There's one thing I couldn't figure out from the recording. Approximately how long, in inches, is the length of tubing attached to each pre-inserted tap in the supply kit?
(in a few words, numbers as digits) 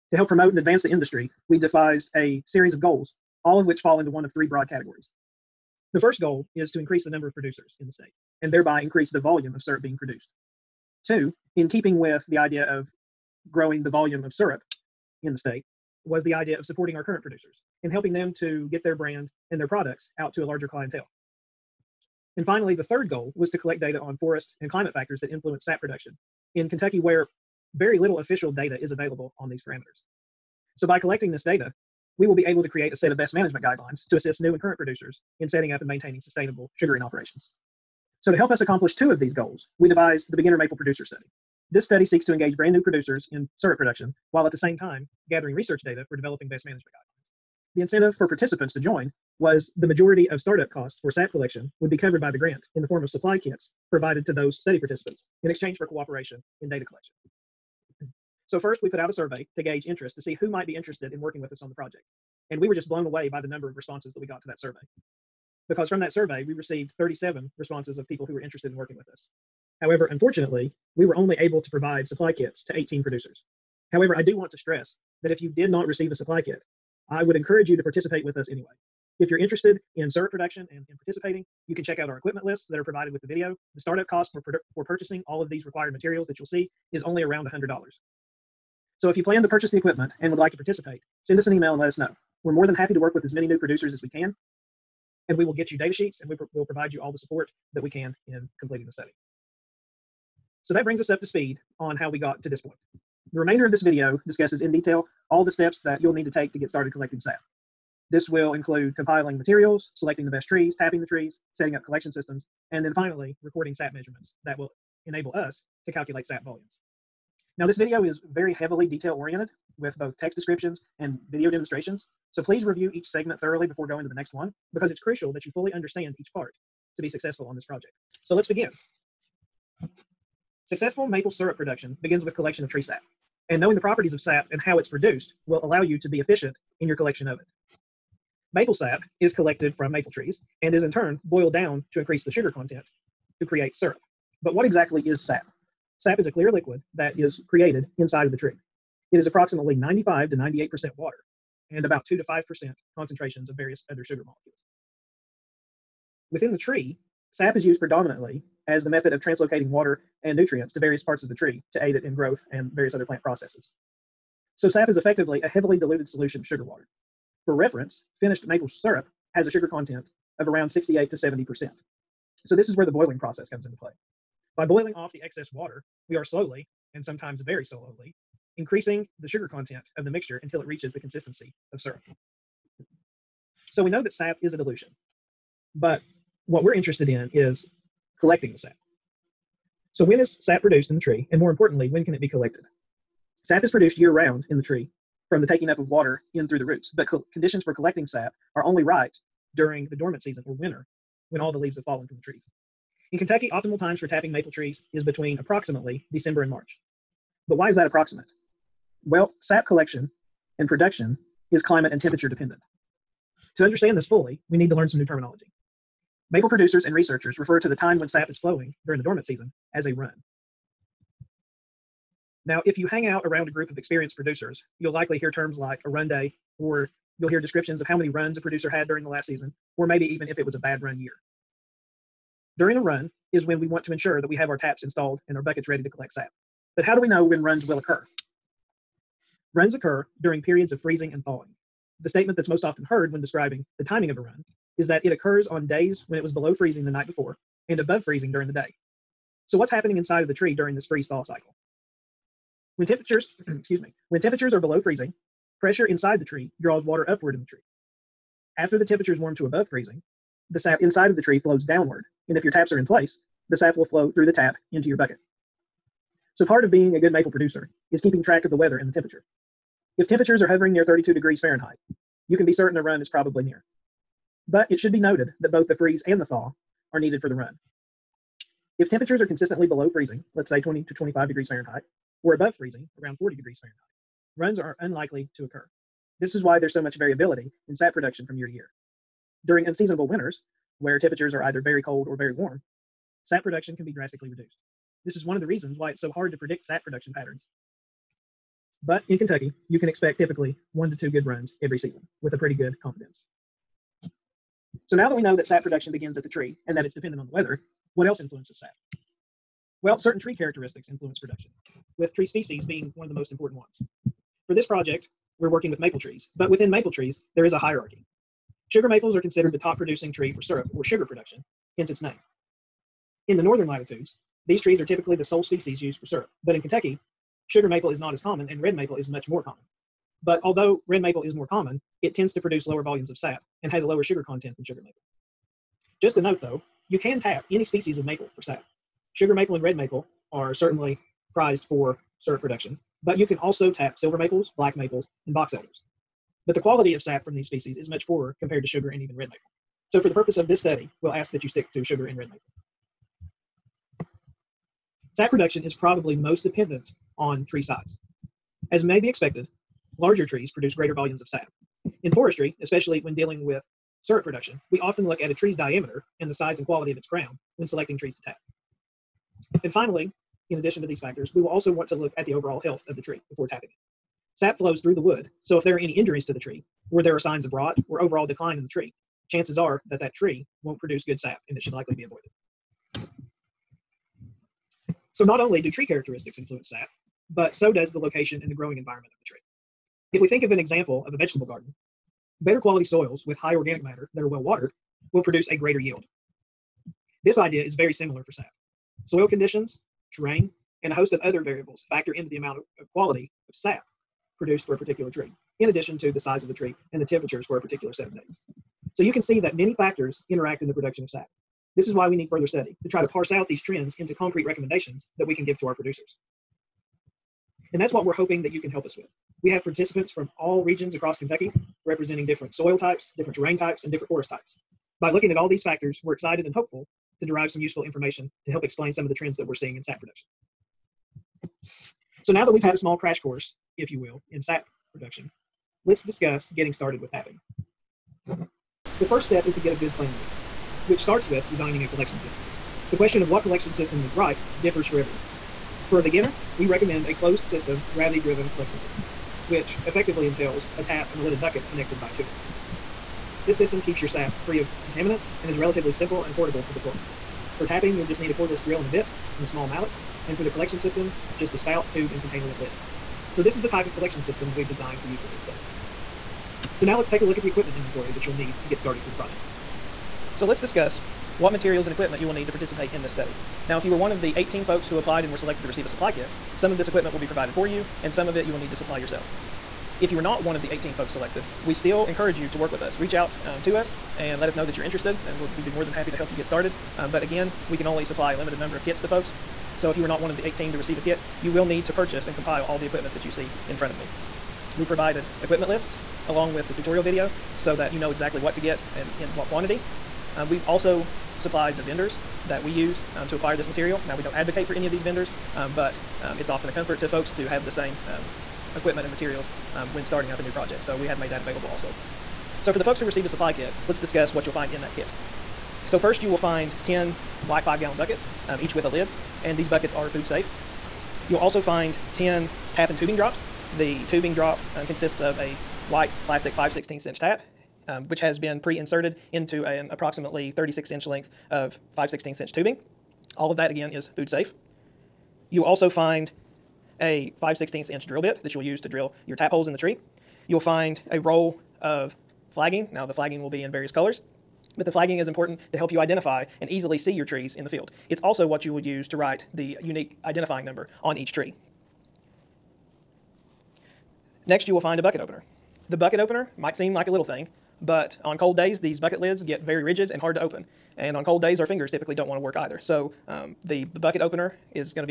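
36 inches.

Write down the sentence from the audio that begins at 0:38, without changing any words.
So, to help us accomplish two of these goals, we devised the Beginner Maple Producer Study.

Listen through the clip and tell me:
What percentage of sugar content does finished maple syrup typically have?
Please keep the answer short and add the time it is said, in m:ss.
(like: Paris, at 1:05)
68 to 70%, at 2:50.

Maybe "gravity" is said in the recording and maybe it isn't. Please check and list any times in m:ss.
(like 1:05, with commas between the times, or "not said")
7:27.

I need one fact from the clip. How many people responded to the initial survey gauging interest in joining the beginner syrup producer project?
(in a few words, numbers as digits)
37.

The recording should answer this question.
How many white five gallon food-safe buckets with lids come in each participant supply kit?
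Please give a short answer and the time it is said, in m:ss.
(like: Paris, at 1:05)
10, at 8:36.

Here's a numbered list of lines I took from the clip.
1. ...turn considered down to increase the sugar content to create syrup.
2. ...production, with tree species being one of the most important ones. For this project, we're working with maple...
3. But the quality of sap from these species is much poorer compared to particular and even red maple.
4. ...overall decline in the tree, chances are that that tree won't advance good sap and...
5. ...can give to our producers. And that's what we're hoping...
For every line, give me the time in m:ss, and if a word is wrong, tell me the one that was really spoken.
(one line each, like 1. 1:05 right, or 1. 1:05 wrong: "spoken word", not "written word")
1. 2:20 wrong: "boiled", not "considered"
2. 5:11 right
3. 5:46 wrong: "sugar", not "particular"
4. 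6:17 wrong: "produce", not "advance"
5. 6:55 right.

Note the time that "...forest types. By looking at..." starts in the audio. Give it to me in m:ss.
7:04.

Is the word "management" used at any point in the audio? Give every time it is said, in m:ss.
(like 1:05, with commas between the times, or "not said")
0:33, 0:46.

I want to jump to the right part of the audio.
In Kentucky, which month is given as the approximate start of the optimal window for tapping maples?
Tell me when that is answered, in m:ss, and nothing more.
3:26.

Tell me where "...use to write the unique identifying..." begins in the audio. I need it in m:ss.
9:08.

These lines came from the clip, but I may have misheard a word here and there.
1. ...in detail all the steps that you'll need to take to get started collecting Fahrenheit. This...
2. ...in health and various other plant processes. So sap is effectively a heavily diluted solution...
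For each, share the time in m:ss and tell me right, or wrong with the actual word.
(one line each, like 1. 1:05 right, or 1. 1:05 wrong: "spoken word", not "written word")
1. 1:44 wrong: "SAP", not "Fahrenheit"
2. 2:42 wrong: "growth", not "health".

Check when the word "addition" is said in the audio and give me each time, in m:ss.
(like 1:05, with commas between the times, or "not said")
6:10, 6:45.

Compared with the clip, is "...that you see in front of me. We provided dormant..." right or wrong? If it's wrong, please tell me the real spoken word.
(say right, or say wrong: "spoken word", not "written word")
wrong: "equipment", not "dormant".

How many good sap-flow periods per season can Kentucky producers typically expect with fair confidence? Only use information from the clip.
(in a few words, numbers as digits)
1 to 2.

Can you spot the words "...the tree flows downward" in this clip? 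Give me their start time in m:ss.
4:21.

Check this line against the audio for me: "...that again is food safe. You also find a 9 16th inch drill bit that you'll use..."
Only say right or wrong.
wrong.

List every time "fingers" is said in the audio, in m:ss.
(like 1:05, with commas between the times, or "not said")
9:21.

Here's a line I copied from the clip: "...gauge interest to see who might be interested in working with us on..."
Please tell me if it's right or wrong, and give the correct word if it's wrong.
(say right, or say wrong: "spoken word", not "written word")
right.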